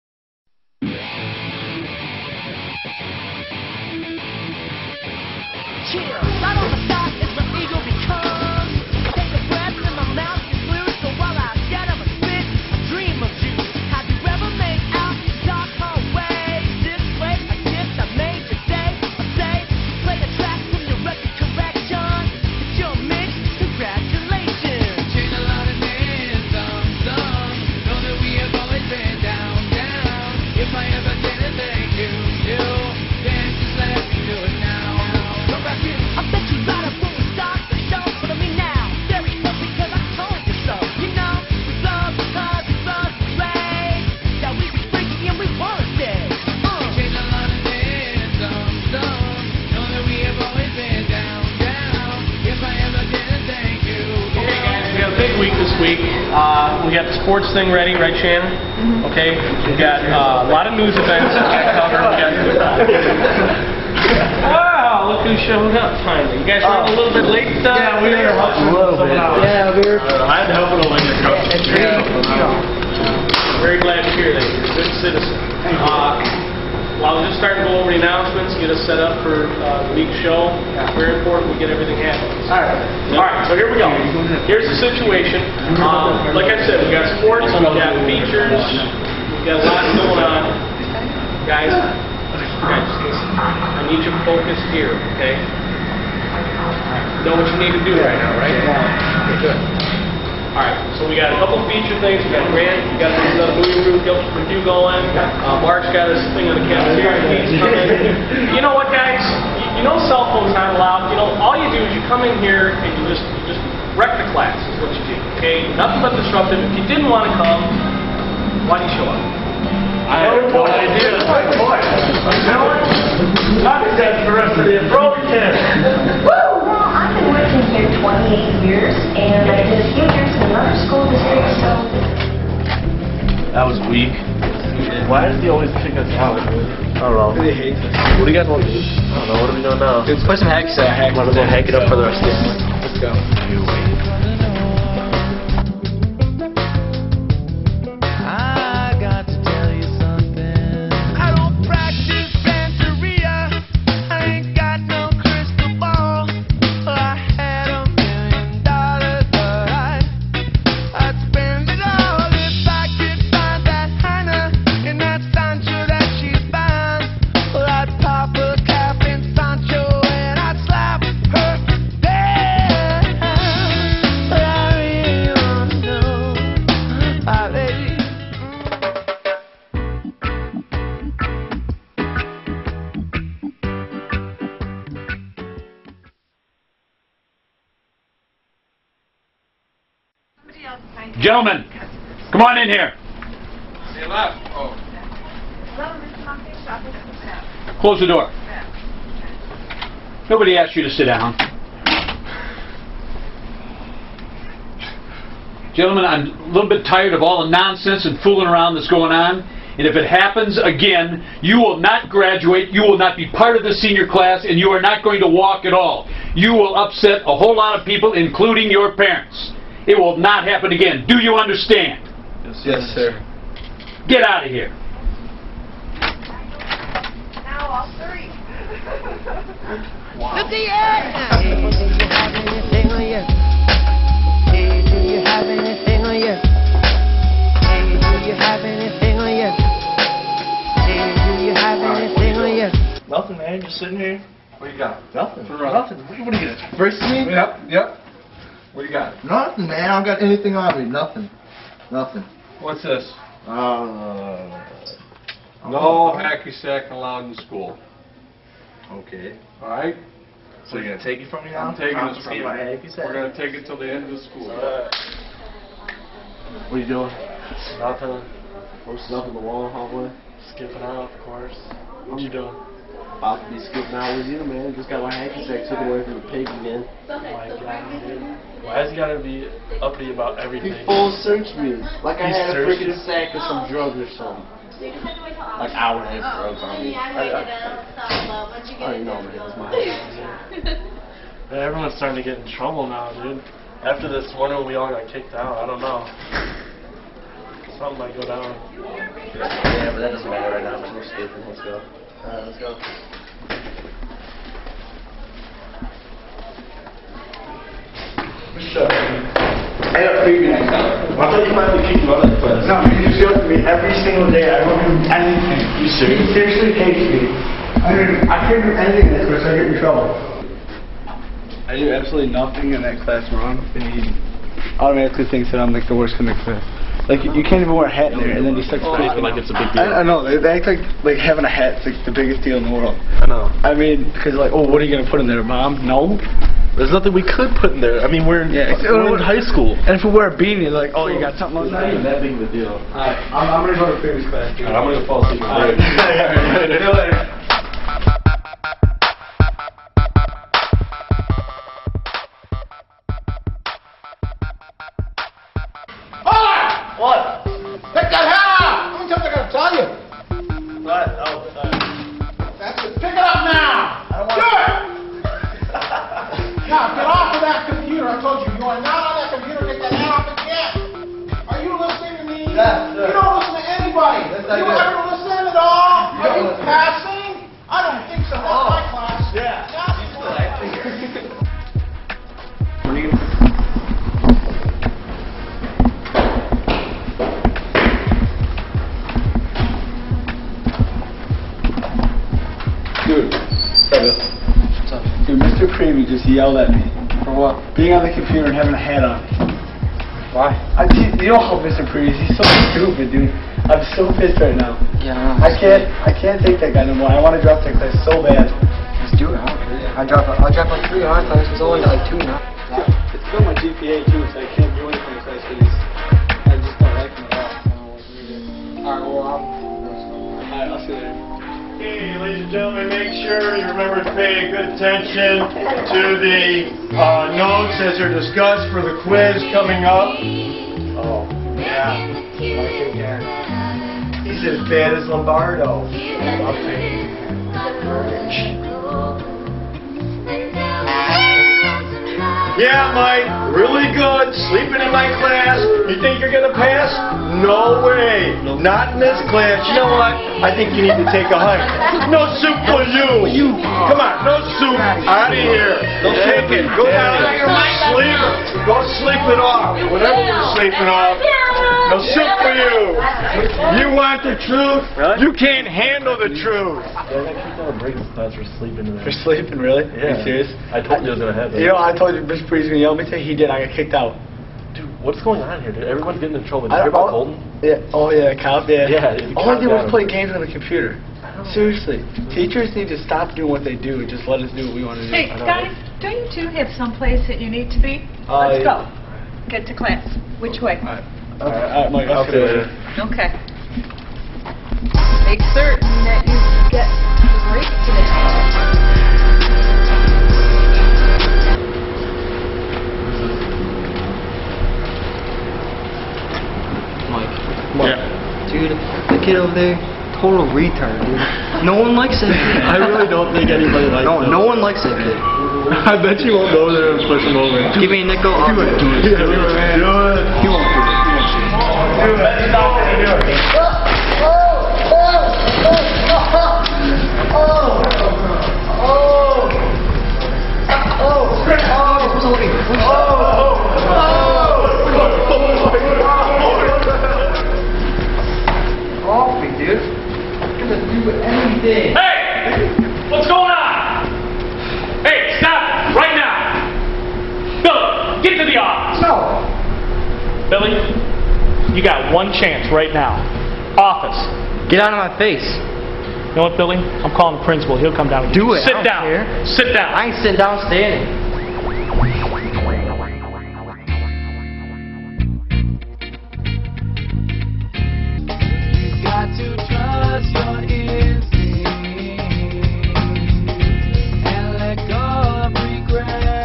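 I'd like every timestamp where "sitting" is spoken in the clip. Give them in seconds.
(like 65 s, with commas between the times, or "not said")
243 s, 560 s.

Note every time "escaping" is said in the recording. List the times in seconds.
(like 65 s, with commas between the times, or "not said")
301 s.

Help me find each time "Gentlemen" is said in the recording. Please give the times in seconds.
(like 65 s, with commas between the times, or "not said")
191 s, 205 s.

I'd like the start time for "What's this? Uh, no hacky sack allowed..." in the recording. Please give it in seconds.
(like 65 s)
252 s.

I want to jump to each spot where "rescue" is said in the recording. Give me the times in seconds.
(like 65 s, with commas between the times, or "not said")
not said.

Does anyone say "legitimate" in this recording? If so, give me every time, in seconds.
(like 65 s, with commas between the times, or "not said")
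not said.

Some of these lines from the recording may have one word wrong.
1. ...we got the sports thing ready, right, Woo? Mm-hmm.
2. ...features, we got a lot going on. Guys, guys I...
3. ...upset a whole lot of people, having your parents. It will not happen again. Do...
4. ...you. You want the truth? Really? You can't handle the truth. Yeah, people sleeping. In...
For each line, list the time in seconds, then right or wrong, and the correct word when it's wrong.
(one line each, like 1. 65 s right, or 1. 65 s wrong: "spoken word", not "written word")
1. 56 s wrong: "Shannon", not "Woo"
2. 88 s right
3. 216 s wrong: "including", not "having"
4. 462 s right.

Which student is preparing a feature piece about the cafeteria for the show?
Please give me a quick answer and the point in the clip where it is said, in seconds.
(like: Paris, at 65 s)
Mark, at 105 s.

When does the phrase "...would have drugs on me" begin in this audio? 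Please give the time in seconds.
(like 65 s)
285 s.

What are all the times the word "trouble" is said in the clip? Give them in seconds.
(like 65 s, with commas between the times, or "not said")
292 s, 319 s, 476 s.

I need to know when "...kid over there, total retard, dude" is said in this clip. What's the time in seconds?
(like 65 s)
509 s.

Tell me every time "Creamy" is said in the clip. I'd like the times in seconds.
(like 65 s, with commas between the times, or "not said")
395 s, 401 s.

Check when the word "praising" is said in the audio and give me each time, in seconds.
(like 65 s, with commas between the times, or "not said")
328 s.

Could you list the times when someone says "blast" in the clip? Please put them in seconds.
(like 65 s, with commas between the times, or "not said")
not said.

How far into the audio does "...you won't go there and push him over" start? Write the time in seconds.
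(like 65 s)
516 s.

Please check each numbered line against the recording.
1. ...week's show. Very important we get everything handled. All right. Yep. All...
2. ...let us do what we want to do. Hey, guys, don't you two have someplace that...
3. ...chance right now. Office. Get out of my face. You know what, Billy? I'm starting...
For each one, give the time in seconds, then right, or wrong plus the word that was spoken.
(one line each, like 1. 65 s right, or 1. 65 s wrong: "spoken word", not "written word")
1. 80 s right
2. 484 s right
3. 552 s wrong: "calling", not "starting".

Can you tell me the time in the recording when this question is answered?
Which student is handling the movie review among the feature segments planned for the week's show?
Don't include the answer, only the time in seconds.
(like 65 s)
102 s.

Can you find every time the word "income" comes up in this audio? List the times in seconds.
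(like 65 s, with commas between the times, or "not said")
not said.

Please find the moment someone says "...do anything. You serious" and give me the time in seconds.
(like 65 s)
314 s.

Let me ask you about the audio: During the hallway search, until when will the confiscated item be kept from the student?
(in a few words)
End of the school.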